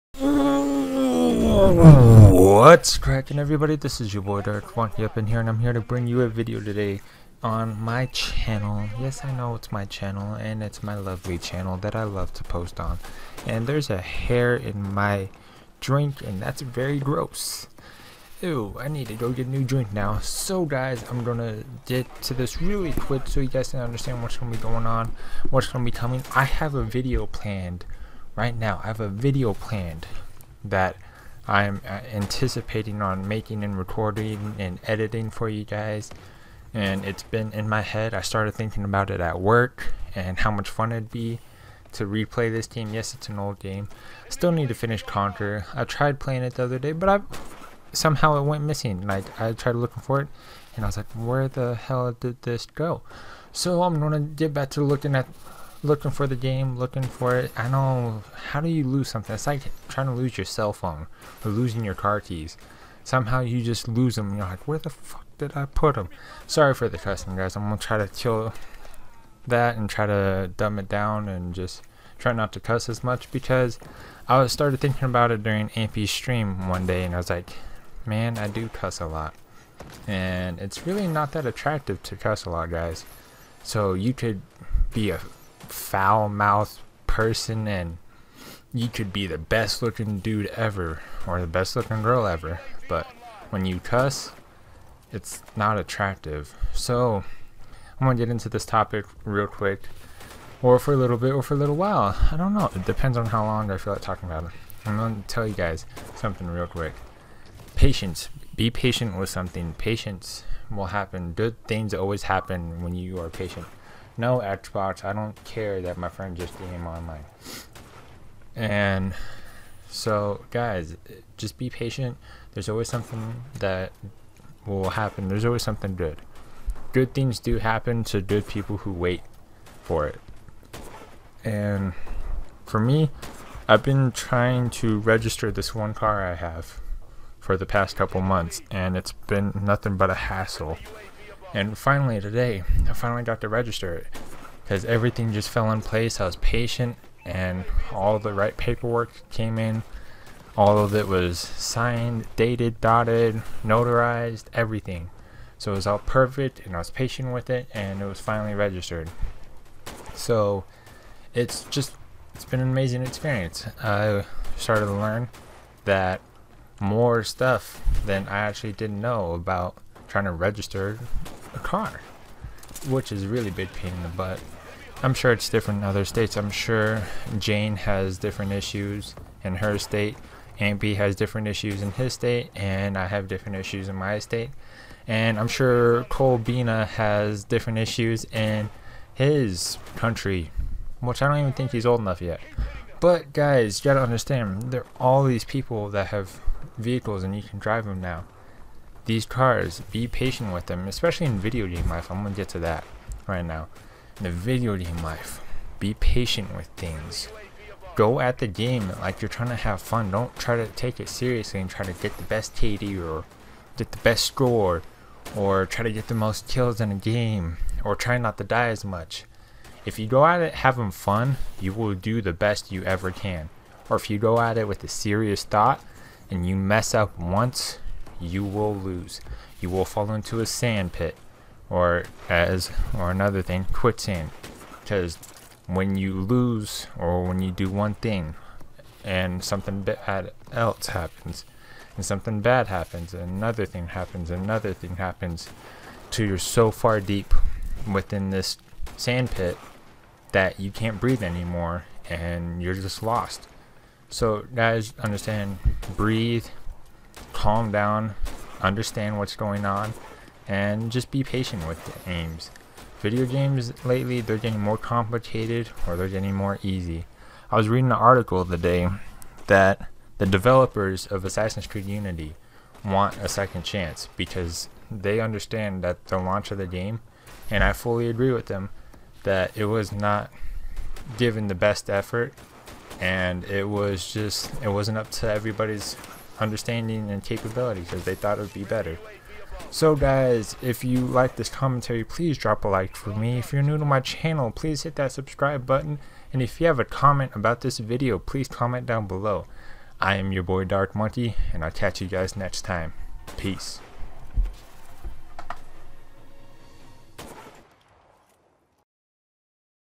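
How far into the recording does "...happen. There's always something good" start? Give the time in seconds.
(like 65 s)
124 s.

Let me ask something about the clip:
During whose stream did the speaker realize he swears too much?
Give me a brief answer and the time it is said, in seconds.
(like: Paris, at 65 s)
Ampy, at 75 s.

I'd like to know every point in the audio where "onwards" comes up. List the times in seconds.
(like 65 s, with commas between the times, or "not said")
not said.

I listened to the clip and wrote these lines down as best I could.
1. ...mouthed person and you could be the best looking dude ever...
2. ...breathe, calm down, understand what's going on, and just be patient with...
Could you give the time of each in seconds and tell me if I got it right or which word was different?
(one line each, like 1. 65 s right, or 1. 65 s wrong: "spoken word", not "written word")
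1. 86 s right
2. 255 s right.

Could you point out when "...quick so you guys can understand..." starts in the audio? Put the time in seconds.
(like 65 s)
22 s.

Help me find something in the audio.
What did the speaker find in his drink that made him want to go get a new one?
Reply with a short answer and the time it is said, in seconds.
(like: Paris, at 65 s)
a hair, at 13 s.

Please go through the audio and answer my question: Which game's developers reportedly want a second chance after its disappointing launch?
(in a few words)
Assassin's Creed Unity.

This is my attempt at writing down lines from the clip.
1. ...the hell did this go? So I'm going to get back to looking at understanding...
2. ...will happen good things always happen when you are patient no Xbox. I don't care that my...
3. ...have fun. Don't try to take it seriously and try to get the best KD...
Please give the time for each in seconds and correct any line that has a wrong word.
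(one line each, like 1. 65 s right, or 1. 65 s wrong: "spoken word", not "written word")
1. 51 s wrong: "looking", not "understanding"
2. 110 s right
3. 209 s right.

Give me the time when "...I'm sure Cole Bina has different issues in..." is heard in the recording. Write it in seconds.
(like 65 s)
185 s.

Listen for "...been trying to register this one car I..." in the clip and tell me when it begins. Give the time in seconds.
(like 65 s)
133 s.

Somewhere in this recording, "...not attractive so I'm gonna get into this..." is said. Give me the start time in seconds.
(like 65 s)
95 s.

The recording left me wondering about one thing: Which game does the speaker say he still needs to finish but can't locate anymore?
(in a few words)
Conquer.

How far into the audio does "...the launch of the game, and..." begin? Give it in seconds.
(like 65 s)
276 s.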